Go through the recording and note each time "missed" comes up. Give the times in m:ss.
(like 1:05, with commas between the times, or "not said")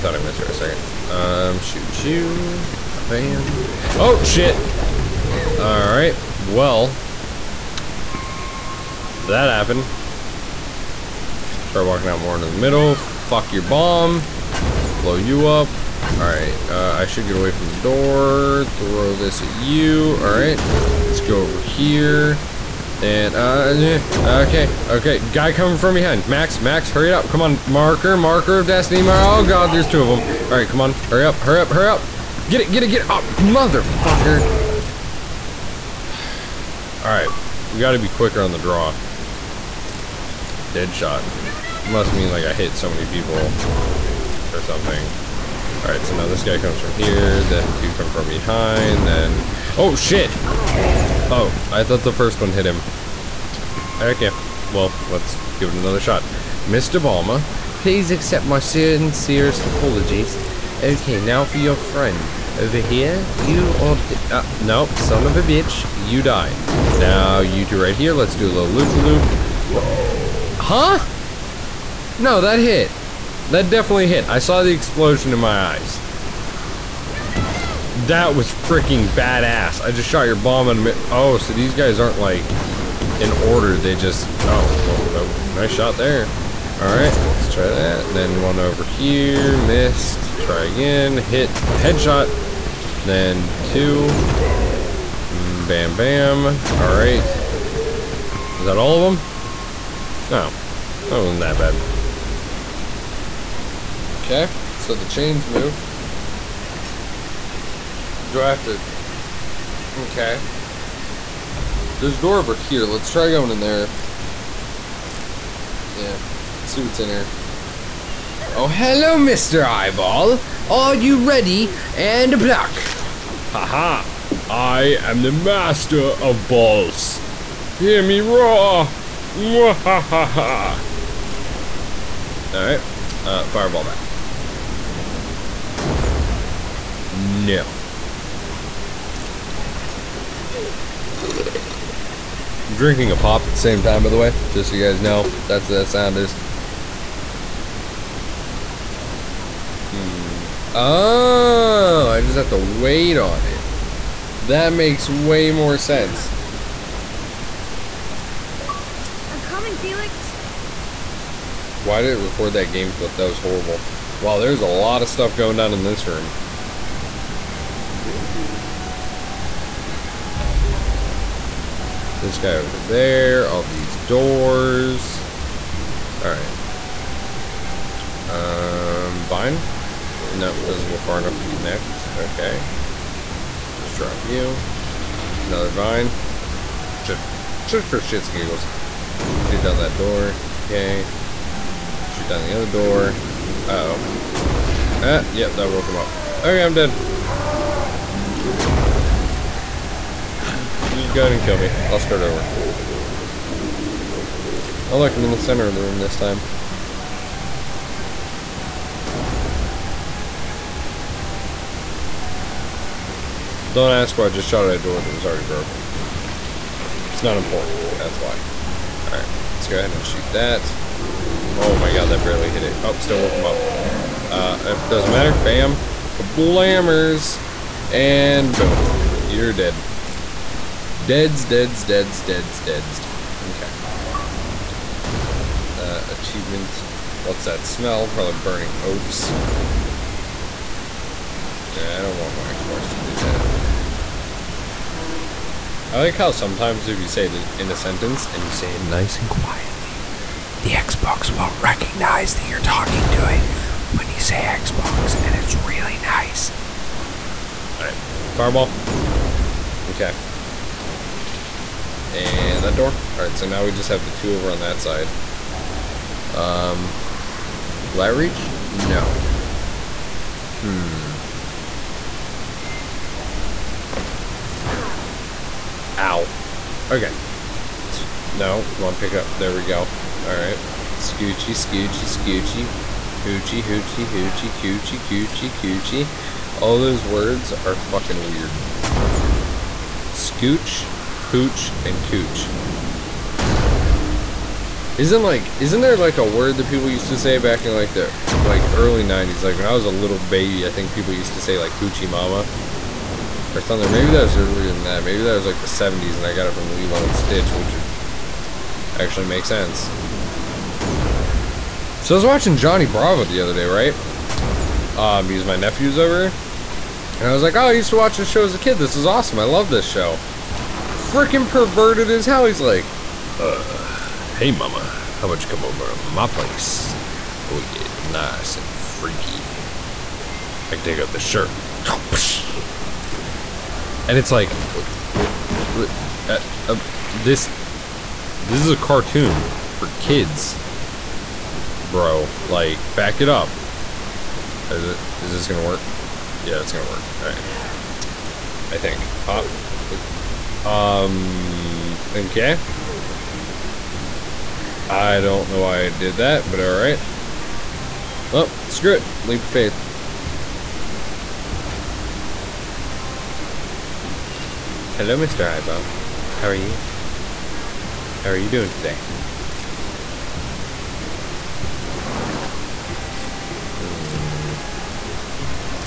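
0:00, 1:29.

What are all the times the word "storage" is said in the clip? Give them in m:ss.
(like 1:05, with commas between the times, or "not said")
not said.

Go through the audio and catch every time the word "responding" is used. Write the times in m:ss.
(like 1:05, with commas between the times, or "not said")
not said.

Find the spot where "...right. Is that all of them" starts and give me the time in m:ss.
1:36.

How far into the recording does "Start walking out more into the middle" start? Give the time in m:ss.
0:11.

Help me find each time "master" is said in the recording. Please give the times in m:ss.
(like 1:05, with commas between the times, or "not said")
2:05.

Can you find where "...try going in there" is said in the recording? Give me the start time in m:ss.
1:53.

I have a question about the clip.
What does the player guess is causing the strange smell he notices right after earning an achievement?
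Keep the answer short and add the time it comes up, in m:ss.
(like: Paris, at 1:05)
burning oafs, at 3:58.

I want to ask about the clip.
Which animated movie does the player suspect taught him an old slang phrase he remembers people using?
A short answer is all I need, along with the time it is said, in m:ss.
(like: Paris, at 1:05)
Lilo and Stitch, at 5:06.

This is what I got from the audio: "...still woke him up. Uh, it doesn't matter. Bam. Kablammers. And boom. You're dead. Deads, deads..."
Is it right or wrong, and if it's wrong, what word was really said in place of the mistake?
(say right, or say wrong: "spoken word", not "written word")
right.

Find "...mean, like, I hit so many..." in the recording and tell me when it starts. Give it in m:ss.
0:42.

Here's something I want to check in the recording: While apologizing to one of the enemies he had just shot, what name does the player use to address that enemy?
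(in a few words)
Mr. Balmer.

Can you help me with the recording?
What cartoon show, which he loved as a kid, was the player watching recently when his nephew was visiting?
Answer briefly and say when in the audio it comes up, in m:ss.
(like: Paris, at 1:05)
Johnny Bravo, at 5:12.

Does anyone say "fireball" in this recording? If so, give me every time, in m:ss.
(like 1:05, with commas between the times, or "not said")
2:13, 4:18.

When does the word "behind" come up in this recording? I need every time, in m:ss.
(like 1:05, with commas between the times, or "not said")
0:25, 0:48.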